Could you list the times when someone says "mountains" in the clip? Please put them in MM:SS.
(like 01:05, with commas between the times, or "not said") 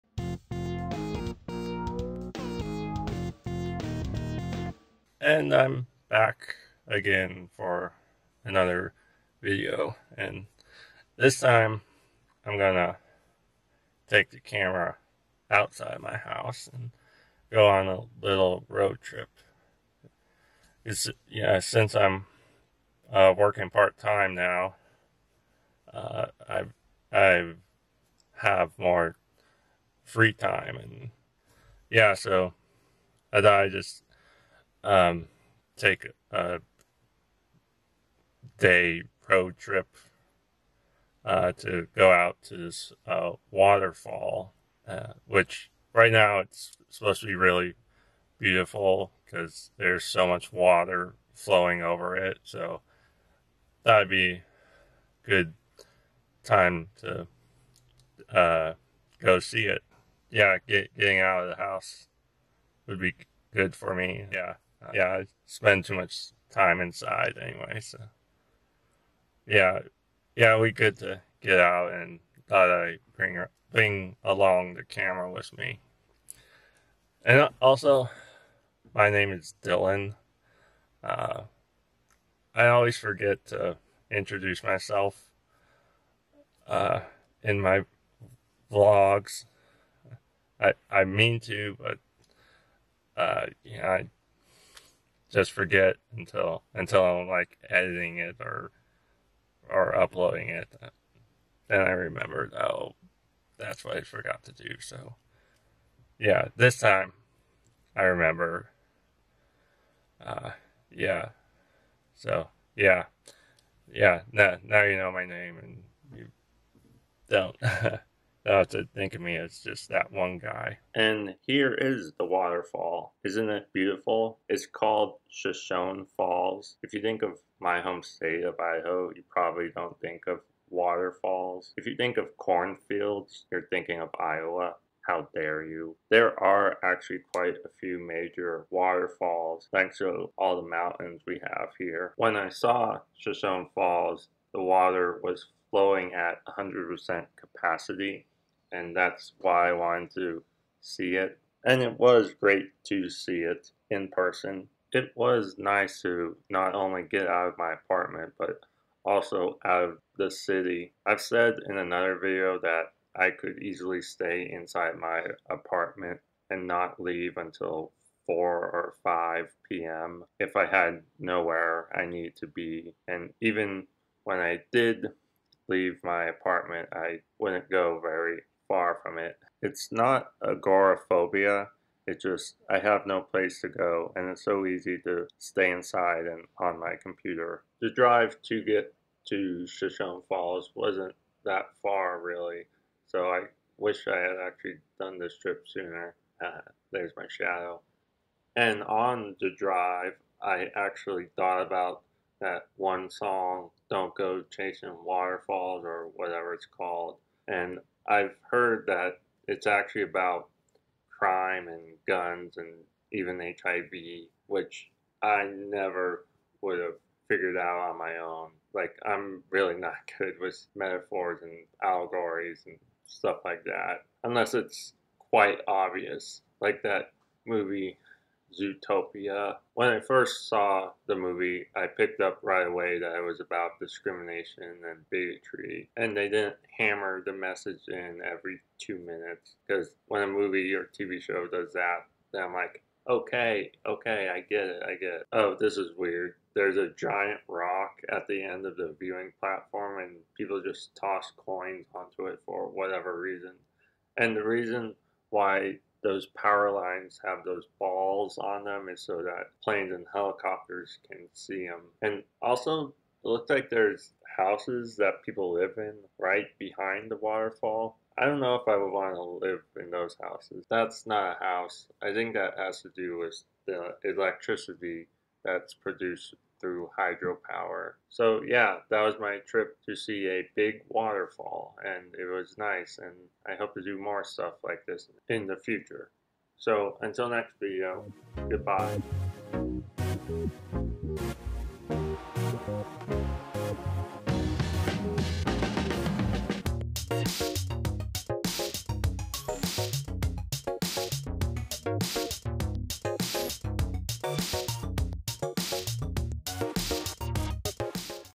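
02:20.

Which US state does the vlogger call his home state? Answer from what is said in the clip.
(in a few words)
Idaho.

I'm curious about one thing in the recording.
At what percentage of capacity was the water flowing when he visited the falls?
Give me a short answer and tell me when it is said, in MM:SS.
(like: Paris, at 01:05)
100%, at 02:26.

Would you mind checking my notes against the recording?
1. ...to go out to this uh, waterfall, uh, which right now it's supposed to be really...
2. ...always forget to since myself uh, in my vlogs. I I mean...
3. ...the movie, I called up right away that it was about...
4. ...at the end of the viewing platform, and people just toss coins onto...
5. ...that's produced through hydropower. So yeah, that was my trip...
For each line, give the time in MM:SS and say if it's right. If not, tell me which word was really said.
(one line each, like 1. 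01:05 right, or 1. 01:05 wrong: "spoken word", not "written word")
1. 00:41 right
2. 01:22 wrong: "introduce", not "since"
3. 03:51 wrong: "picked", not "called"
4. 04:08 right
5. 04:35 right.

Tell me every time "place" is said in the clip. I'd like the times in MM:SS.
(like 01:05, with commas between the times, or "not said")
03:03.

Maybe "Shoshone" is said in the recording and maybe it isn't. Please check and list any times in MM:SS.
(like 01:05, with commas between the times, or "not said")
02:05, 02:23, 03:09.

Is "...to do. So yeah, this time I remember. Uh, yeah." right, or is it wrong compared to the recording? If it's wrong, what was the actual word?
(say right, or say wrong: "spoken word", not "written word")
right.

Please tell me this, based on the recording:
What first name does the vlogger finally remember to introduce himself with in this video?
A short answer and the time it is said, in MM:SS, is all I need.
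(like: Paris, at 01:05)
Dylan, at 01:19.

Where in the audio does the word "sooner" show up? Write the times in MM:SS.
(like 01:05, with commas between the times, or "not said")
03:15.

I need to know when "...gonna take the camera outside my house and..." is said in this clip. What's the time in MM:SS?
00:12.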